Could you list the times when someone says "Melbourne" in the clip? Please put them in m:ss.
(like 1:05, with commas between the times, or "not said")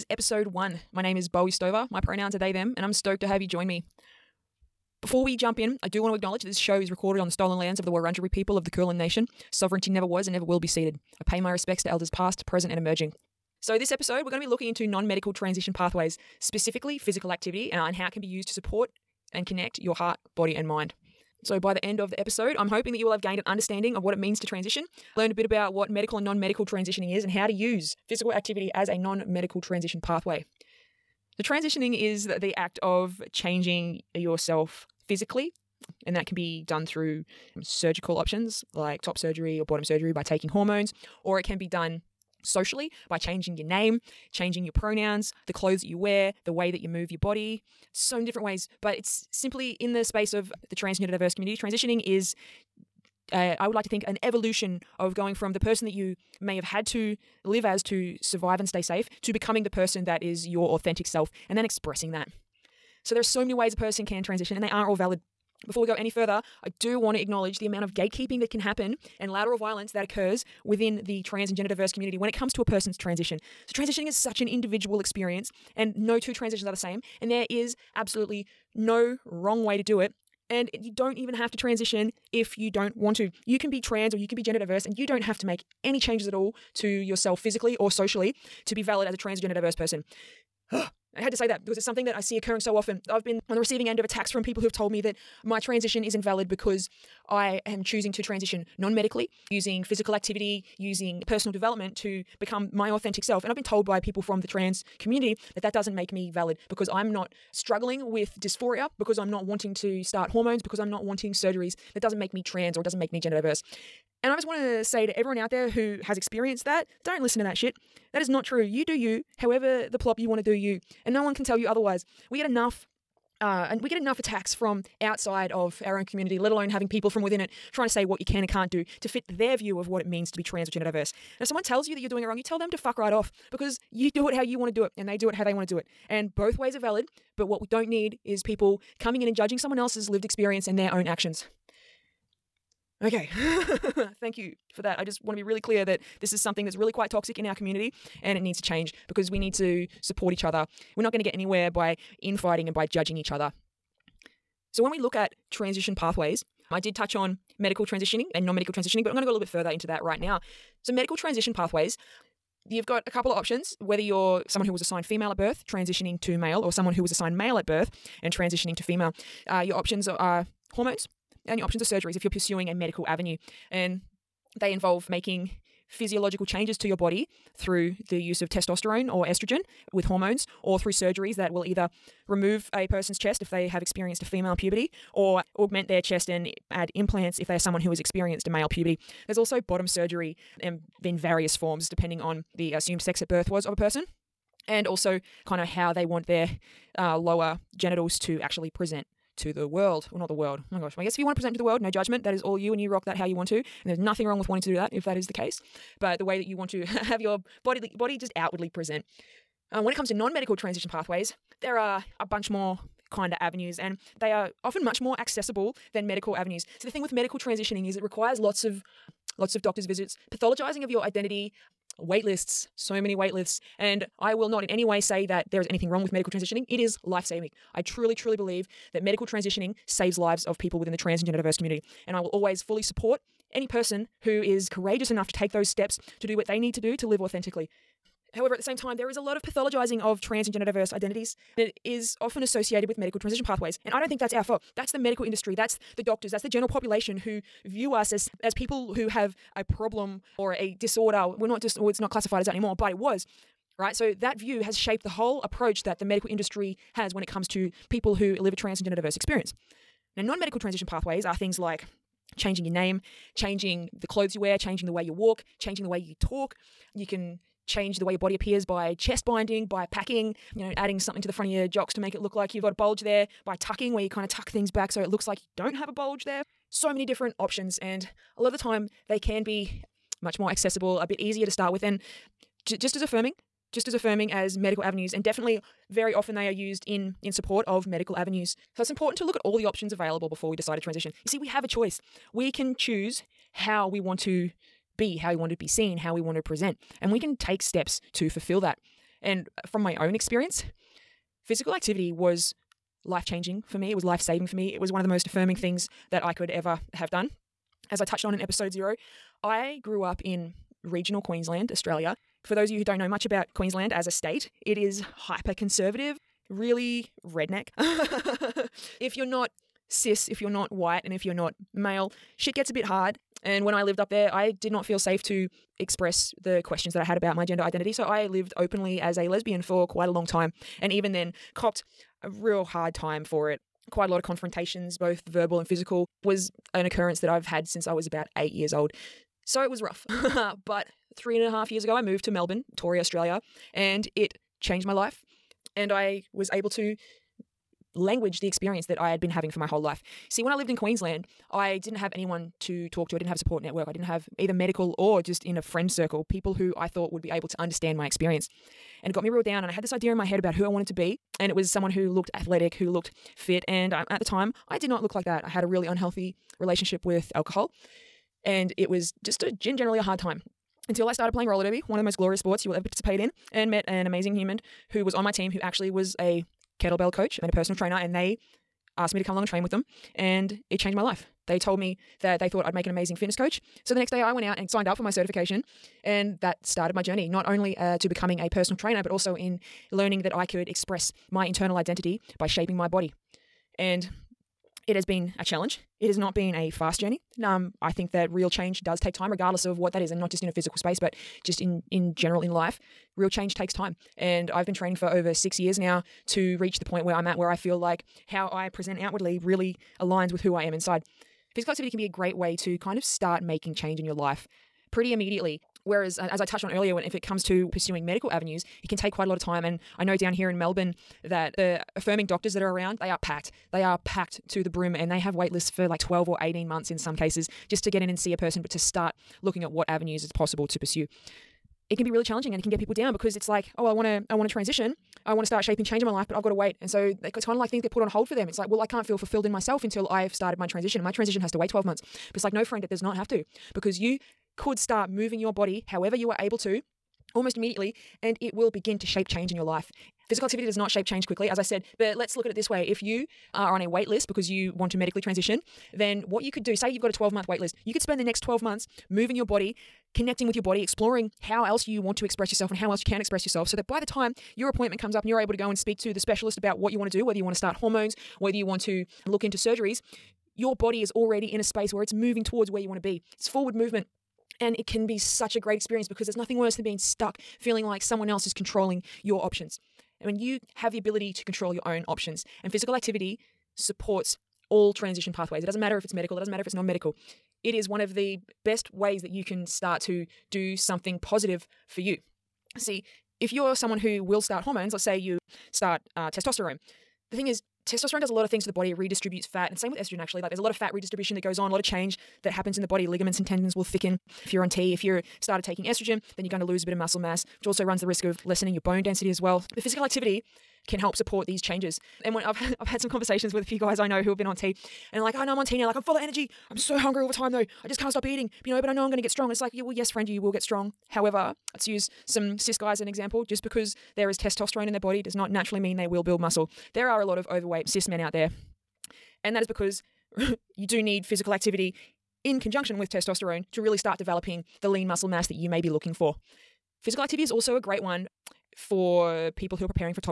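5:42, 7:00.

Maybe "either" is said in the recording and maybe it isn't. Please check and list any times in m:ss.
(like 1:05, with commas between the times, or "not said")
3:01, 5:54.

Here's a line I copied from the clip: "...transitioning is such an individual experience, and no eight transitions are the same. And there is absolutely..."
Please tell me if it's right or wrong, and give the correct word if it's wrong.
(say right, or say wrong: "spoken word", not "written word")
wrong: "two", not "eight".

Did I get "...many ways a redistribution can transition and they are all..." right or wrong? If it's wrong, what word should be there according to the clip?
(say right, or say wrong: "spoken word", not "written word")
wrong: "person", not "redistribution".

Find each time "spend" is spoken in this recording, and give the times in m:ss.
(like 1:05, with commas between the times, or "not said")
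7:38.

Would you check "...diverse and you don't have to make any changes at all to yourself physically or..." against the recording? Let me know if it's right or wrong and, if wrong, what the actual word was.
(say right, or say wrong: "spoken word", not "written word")
right.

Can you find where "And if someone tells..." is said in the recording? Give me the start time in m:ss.
2:11.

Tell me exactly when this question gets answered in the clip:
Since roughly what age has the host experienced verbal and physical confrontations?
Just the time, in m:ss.
5:38.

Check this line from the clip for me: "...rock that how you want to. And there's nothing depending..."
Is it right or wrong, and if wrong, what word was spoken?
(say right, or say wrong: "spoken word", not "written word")
wrong: "wrong", not "depending".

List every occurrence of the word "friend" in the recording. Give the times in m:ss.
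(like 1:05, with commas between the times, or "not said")
5:55, 7:22, 8:40.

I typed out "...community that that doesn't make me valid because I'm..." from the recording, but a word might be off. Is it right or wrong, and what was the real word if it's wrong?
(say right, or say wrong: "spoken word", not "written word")
right.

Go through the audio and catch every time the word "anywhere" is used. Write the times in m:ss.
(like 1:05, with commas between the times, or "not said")
2:31.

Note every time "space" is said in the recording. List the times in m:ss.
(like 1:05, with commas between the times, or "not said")
0:50, 6:40, 7:51.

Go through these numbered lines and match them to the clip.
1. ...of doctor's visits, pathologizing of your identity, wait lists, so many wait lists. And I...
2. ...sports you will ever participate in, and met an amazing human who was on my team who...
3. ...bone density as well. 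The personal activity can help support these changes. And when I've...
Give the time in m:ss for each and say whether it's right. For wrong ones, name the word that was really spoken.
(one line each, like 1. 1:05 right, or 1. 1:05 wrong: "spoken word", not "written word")
1. 3:39 right
2. 6:12 right
3. 8:28 wrong: "physical", not "personal".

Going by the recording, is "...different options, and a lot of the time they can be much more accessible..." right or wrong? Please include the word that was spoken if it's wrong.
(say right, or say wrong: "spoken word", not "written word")
right.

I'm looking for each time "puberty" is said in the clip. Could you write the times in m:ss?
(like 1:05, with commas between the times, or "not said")
3:04, 3:08.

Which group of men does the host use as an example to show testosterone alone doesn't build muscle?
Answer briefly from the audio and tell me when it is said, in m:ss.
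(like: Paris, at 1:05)
Cis guys, at 8:42.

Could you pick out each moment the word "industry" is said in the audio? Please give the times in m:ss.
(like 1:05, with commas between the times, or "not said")
4:05, 4:16.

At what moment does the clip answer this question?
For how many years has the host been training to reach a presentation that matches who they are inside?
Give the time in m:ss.
6:45.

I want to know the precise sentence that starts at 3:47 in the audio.
I truly, truly believe that medical transitioning saves lives of people within the trans and gender diverse community.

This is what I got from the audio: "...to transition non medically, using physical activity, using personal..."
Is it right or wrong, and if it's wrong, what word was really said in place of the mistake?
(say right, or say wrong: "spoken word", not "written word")
right.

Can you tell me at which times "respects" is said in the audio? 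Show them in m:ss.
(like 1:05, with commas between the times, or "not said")
0:11.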